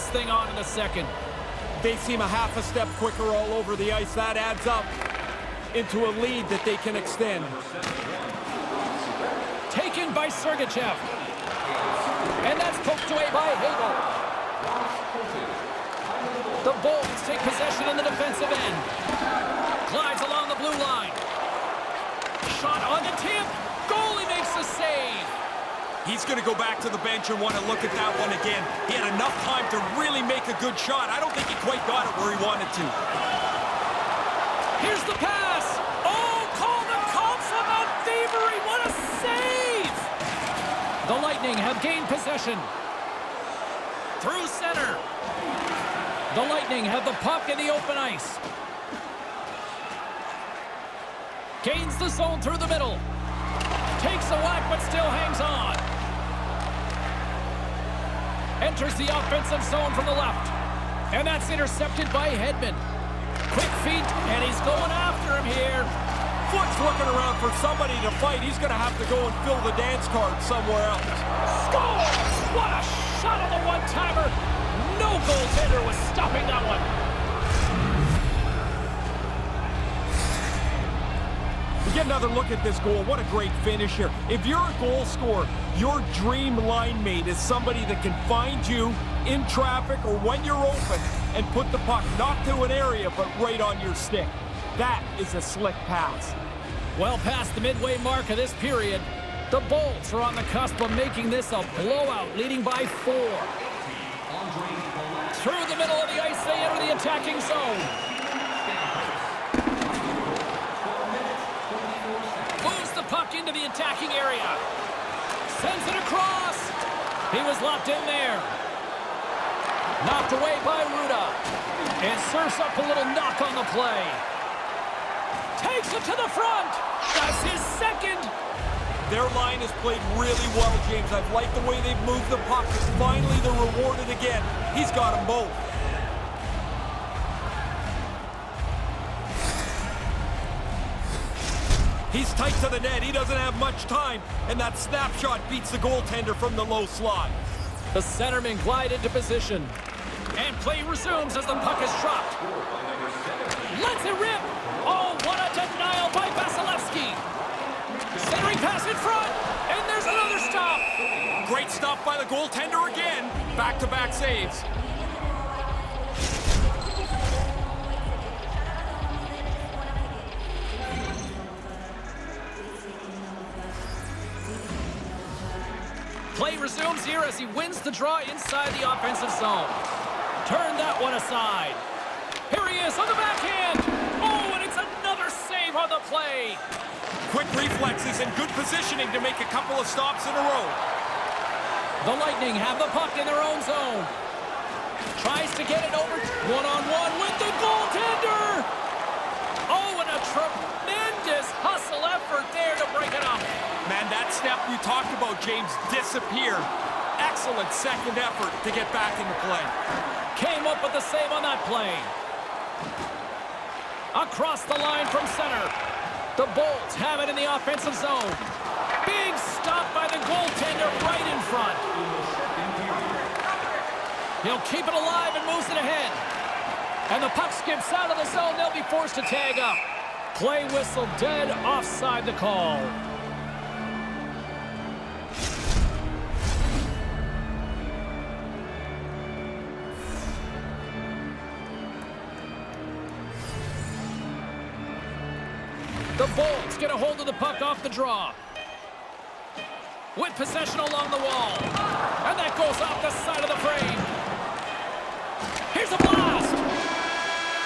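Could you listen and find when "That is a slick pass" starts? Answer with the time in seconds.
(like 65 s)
94 s.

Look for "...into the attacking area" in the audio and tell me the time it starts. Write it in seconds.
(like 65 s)
113 s.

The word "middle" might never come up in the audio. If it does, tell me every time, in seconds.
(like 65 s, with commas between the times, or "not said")
52 s, 105 s.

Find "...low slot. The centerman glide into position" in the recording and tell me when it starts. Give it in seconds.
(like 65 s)
146 s.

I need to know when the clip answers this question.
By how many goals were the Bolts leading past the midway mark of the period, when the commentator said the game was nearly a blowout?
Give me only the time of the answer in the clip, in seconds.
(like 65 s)
102 s.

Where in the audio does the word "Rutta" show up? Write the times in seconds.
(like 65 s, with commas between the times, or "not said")
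120 s.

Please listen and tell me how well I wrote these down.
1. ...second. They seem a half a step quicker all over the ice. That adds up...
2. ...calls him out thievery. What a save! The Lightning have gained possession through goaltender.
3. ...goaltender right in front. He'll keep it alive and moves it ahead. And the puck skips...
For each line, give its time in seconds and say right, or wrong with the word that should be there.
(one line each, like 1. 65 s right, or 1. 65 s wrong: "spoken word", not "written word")
1. 0 s right
2. 37 s wrong: "center", not "goaltender"
3. 220 s right.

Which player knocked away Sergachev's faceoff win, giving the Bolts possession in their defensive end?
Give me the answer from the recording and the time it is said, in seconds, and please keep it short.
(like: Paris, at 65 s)
Hagel, at 13 s.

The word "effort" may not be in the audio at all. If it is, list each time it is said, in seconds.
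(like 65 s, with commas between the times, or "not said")
202 s, 208 s.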